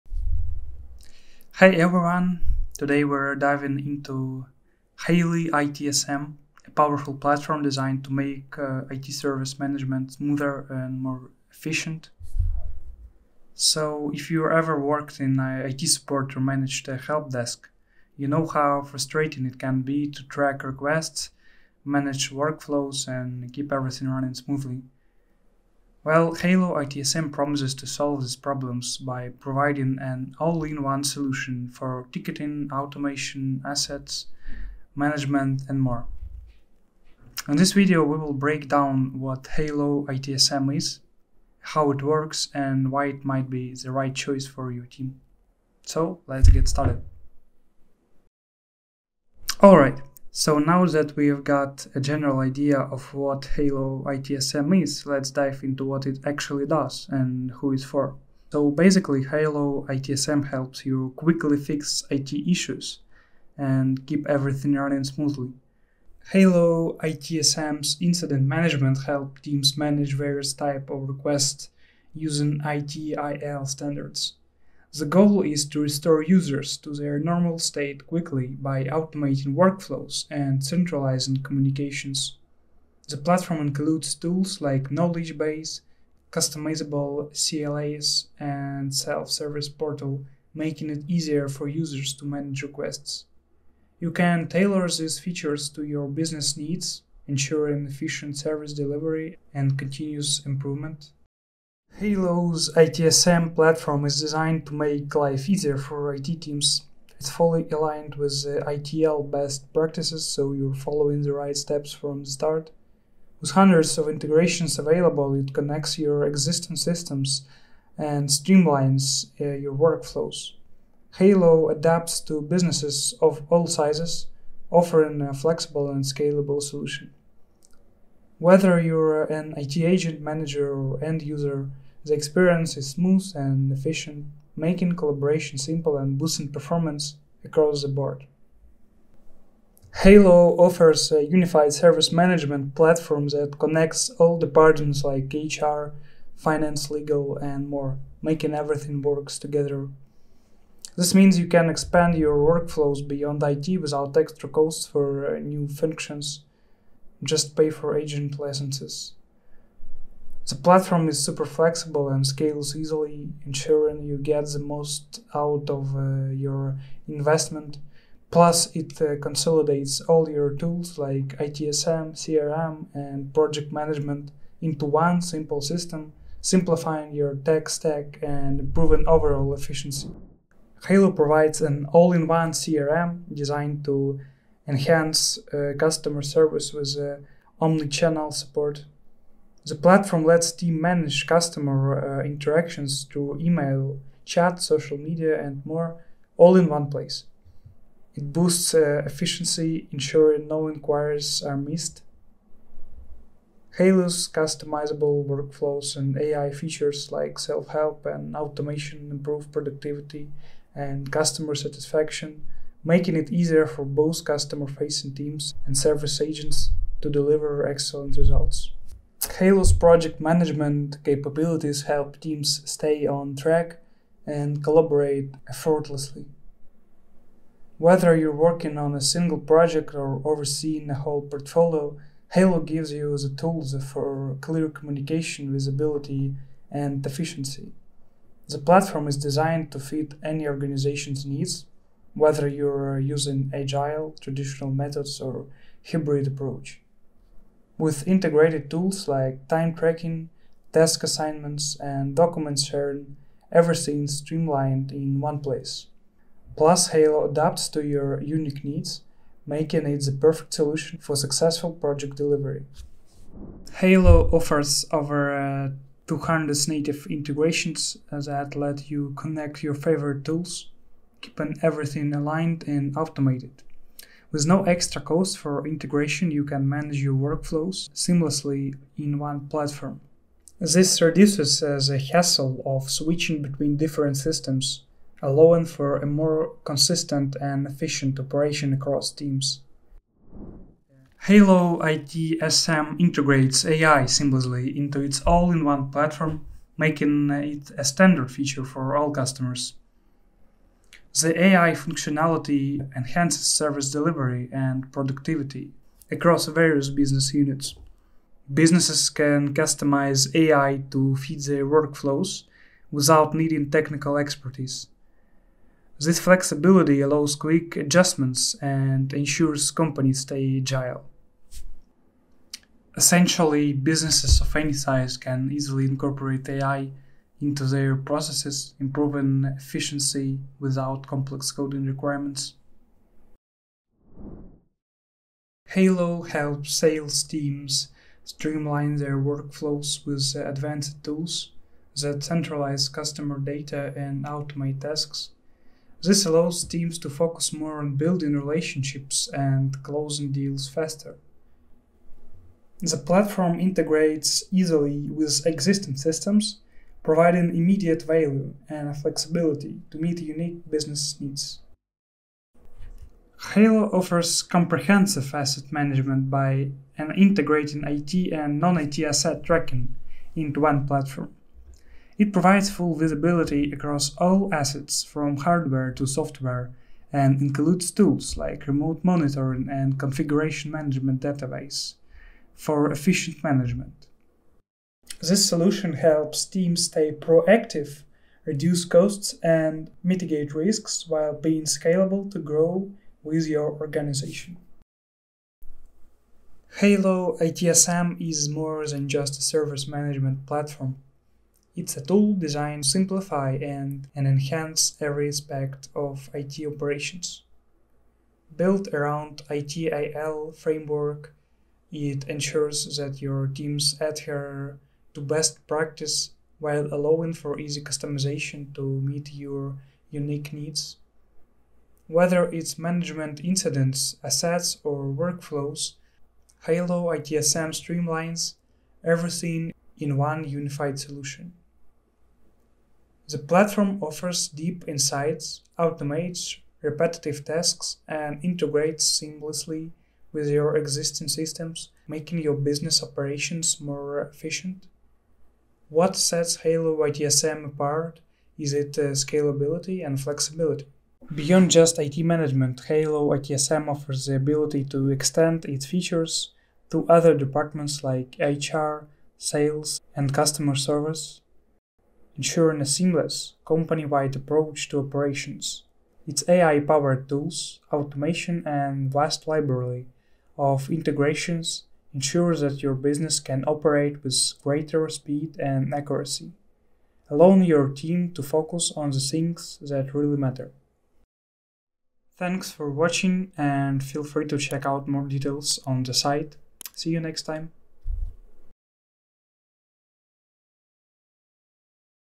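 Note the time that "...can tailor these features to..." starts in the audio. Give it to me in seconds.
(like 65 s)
94 s.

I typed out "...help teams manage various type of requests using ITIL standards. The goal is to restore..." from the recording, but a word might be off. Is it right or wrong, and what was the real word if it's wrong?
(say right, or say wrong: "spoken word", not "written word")
right.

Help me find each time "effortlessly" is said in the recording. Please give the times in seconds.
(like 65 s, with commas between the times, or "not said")
225 s.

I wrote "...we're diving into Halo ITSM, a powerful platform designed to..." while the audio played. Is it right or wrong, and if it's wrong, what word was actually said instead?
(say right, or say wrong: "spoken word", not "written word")
right.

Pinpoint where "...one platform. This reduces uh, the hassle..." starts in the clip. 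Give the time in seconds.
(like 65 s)
279 s.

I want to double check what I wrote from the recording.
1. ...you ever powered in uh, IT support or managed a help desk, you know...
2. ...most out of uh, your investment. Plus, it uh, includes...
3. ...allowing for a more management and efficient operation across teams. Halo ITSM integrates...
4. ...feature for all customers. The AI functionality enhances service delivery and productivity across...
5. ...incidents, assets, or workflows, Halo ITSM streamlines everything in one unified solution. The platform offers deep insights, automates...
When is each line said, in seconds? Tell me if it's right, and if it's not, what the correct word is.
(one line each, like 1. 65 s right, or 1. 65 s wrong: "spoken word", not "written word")
1. 14 s wrong: "worked", not "powered"
2. 164 s wrong: "consolidates", not "includes"
3. 285 s wrong: "consistent", not "management"
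4. 298 s right
5. 423 s right.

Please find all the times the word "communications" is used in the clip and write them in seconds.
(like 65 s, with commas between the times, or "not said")
81 s, 234 s.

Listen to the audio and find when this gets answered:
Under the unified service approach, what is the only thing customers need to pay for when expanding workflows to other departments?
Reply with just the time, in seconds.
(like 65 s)
157 s.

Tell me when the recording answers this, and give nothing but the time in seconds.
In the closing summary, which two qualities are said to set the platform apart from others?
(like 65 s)
449 s.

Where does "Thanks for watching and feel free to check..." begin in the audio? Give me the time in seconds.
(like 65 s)
482 s.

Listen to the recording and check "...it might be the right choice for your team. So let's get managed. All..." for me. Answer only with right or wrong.
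wrong.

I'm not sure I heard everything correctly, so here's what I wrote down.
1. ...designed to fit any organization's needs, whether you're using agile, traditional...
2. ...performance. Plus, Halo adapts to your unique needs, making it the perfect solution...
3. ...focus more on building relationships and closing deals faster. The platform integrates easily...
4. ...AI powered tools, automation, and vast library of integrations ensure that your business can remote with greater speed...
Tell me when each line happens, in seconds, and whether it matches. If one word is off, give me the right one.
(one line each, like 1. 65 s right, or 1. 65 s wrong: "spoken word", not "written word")
1. 239 s right
2. 255 s wrong: "place", not "performance"
3. 347 s right
4. 466 s wrong: "operate", not "remote".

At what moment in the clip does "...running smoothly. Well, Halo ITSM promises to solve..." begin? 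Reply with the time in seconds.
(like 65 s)
24 s.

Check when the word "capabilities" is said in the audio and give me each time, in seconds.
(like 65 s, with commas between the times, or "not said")
221 s.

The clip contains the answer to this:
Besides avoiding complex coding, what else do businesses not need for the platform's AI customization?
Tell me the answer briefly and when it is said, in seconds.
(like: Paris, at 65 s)
Technical expertise, at 313 s.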